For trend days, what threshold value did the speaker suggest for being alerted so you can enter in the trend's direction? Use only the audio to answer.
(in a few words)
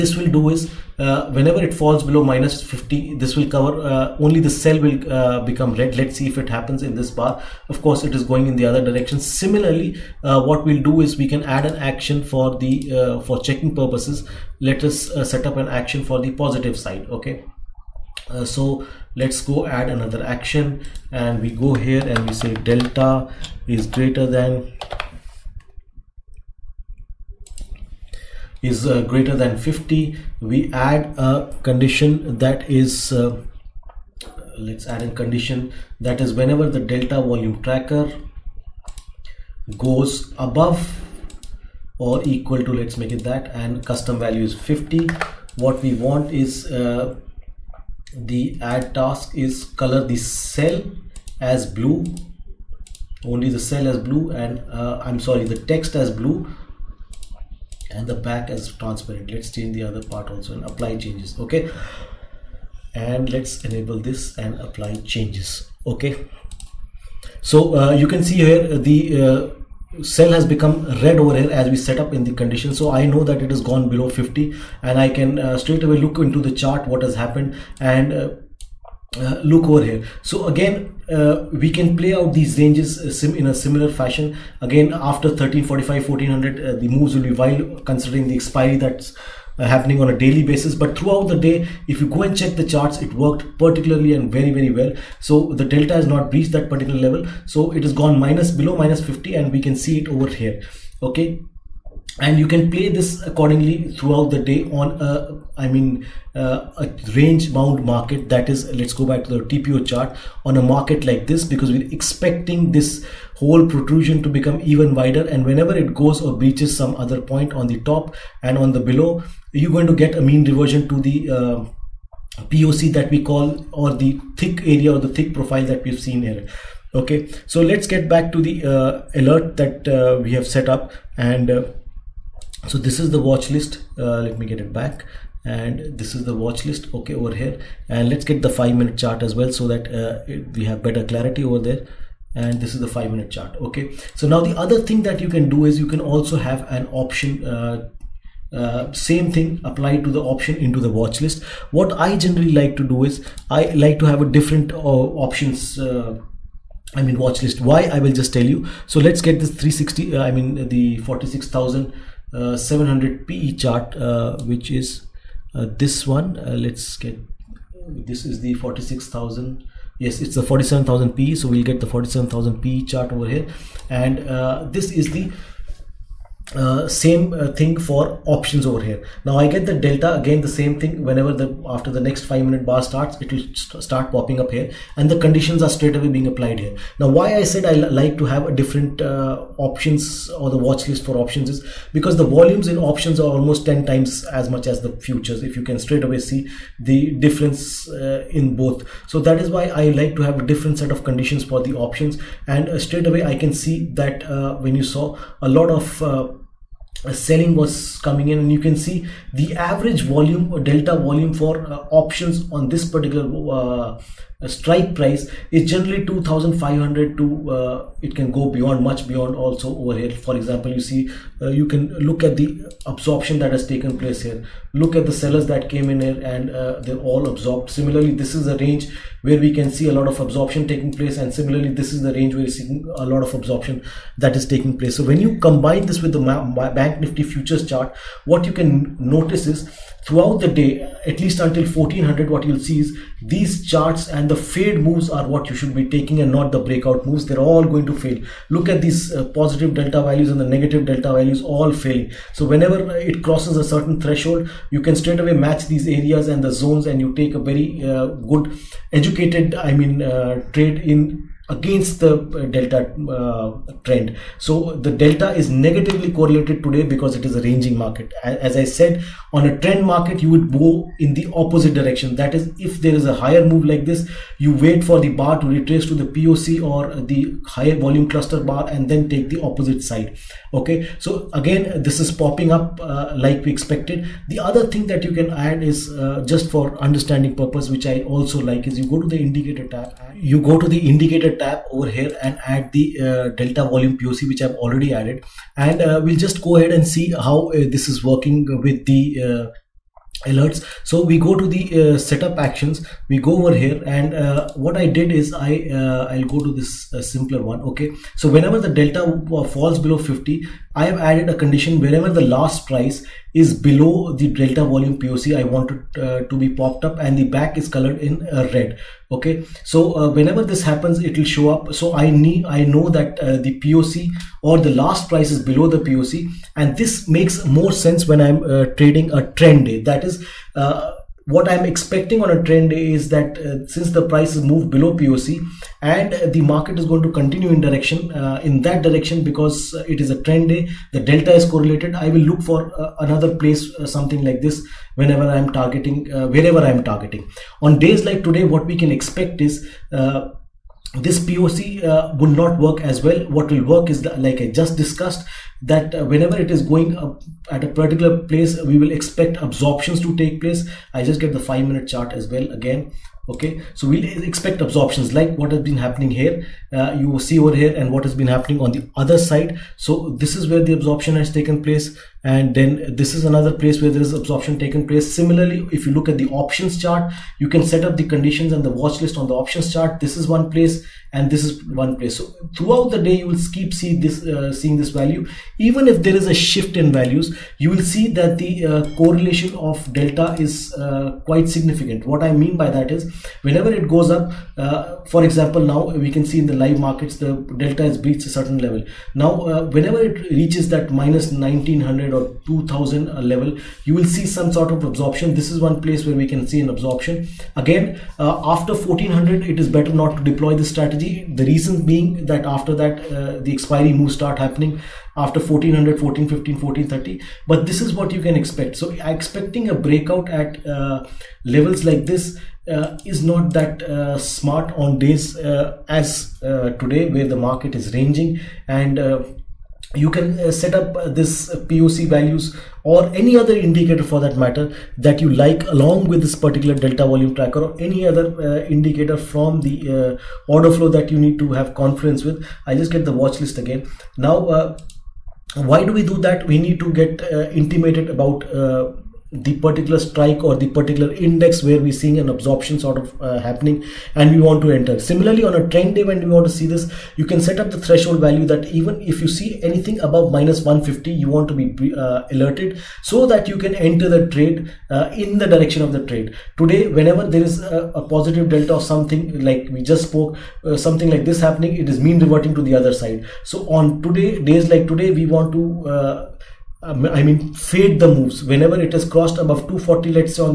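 -150.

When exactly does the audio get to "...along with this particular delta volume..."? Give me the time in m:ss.
7:15.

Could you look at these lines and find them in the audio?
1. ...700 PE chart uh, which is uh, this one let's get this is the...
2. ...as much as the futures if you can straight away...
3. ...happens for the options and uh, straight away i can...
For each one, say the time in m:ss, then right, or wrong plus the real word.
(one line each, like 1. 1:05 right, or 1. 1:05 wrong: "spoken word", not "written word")
1. 2:42 right
2. 3:14 right
3. 3:21 wrong: "conditions", not "happens".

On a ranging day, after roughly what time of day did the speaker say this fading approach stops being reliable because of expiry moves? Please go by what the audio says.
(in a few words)
1400.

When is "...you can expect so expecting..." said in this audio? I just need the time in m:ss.
6:58.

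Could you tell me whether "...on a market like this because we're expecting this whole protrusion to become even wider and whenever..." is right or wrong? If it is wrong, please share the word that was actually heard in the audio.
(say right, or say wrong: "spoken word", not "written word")
right.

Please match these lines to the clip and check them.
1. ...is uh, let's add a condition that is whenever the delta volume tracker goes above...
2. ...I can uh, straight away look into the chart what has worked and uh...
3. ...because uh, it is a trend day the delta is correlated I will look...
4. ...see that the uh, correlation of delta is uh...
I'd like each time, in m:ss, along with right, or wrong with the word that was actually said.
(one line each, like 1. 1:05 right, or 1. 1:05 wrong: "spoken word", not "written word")
1. 0:32 right
2. 1:14 wrong: "happened", not "worked"
3. 5:39 right
4. 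6:27 right.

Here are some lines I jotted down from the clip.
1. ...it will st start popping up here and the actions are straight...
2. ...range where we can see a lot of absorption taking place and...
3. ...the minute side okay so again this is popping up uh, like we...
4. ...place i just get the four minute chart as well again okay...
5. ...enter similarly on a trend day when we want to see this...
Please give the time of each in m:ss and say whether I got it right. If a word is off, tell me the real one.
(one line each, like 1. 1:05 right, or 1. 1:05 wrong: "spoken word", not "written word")
1. 3:03 wrong: "conditions", not "actions"
2. 3:48 right
3. 4:39 wrong: "opposite", not "minute"
4. 6:00 wrong: "five", not "four"
5. 7:34 right.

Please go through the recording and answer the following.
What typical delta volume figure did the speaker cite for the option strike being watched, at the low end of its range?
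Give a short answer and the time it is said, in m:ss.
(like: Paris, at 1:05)
2500, at 3:36.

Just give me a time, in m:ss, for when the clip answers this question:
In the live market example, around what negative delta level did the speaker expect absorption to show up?
6:41.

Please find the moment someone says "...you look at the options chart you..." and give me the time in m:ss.
6:15.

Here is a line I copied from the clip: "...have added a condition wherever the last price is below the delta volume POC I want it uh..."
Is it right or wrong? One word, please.
right.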